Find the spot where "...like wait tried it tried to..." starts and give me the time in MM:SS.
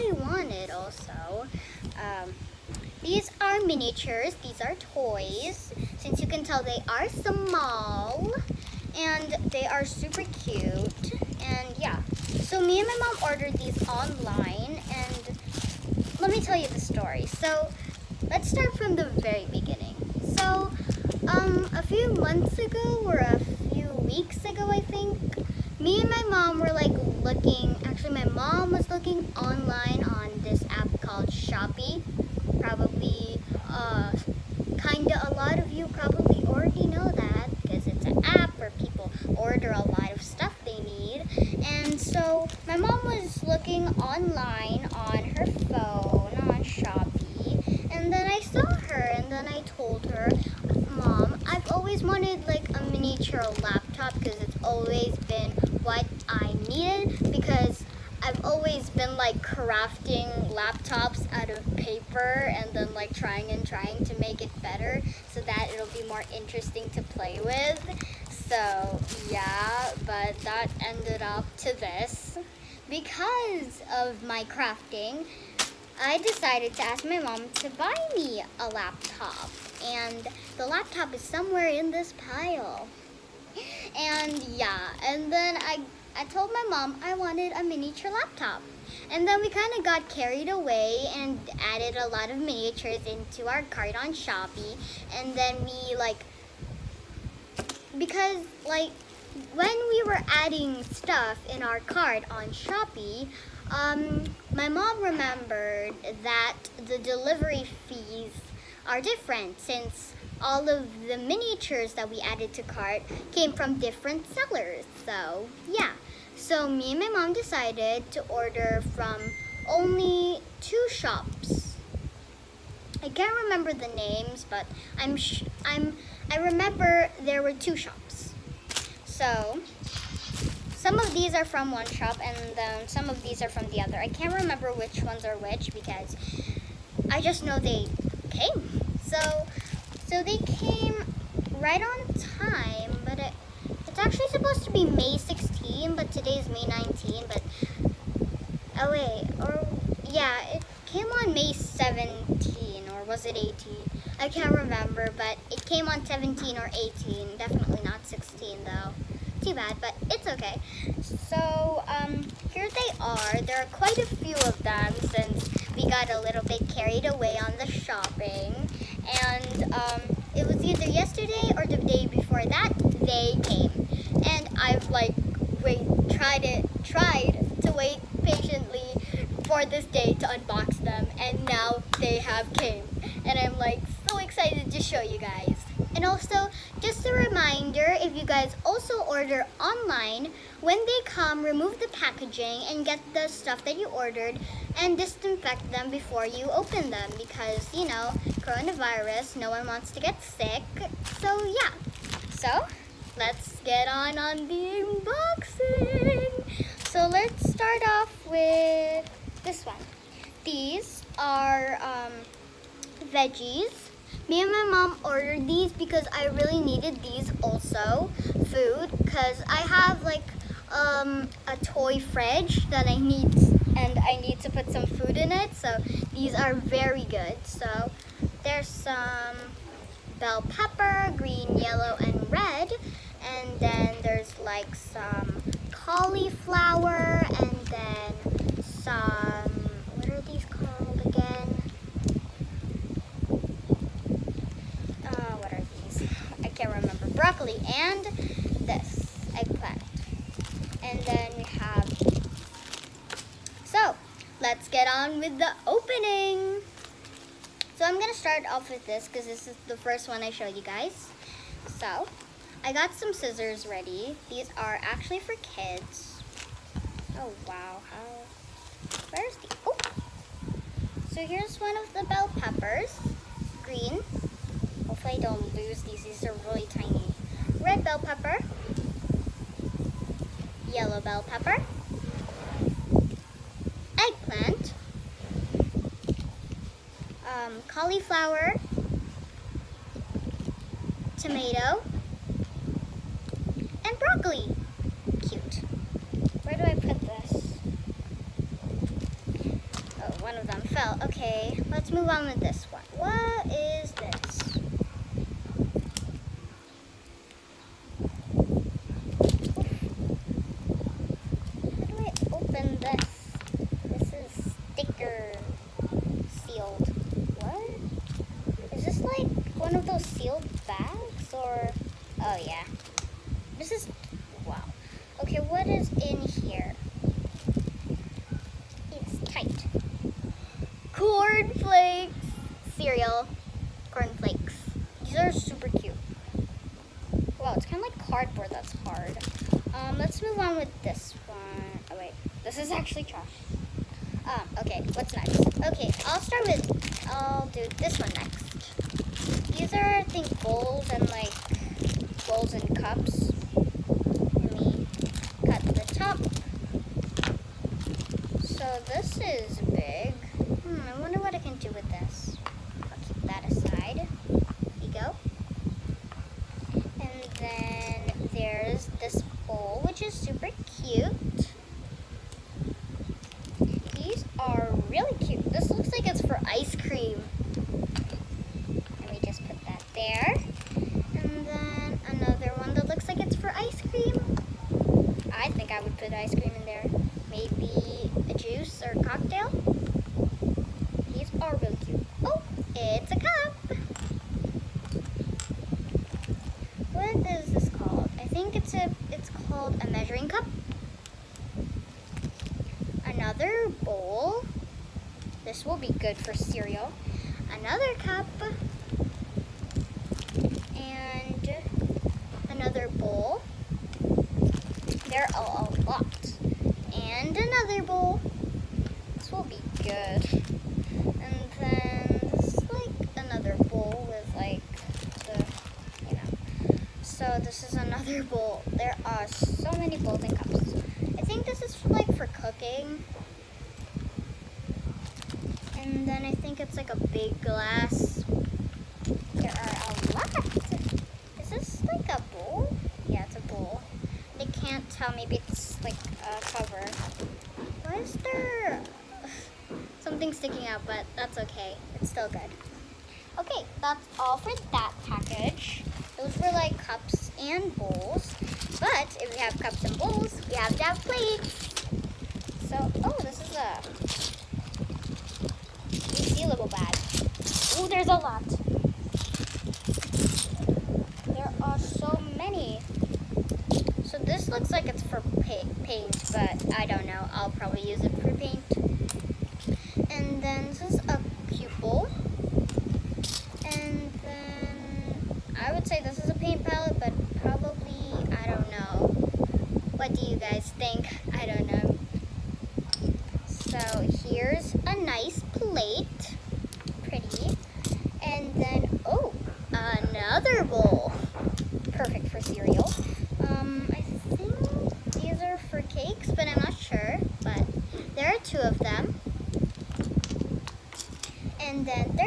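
02:54.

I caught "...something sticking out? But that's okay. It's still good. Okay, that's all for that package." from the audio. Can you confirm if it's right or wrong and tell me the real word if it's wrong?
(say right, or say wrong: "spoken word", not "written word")
right.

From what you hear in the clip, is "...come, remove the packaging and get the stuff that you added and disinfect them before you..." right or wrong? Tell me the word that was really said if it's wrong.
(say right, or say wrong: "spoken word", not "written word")
wrong: "ordered", not "added".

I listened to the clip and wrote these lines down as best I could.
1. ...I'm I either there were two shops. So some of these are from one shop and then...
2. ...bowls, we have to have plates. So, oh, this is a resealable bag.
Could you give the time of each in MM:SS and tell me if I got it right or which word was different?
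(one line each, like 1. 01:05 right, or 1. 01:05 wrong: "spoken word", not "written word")
1. 02:05 wrong: "remember", not "either"
2. 07:39 right.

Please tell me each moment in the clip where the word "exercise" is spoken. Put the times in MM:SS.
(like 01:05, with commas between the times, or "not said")
not said.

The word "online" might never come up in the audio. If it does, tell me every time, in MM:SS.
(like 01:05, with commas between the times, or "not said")
00:13, 00:29, 00:43, 03:09.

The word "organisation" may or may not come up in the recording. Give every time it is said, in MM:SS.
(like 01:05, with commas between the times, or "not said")
not said.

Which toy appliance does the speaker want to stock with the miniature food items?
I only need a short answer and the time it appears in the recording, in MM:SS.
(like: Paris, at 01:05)
fridge, at 03:41.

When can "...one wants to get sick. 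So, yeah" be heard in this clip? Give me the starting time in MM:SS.
03:19.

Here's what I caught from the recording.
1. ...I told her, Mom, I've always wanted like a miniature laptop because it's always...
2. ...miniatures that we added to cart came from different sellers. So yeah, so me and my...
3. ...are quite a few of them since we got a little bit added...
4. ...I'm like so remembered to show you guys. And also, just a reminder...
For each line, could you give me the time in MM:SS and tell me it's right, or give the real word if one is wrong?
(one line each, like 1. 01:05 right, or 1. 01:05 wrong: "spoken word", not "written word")
1. 00:49 right
2. 01:51 right
3. 02:43 wrong: "carried", not "added"
4. 03:03 wrong: "excited", not "remembered".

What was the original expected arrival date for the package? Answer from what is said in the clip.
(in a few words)
May 16.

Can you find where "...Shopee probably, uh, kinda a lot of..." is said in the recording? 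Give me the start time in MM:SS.
00:31.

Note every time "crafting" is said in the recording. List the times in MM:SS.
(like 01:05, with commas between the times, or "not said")
00:59, 01:14.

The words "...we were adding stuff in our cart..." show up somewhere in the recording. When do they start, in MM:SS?
01:39.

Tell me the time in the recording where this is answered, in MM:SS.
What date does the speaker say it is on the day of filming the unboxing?
02:26.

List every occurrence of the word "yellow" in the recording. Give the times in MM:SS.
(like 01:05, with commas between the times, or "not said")
03:51, 04:40.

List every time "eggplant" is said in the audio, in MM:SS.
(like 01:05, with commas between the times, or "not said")
04:09, 04:44.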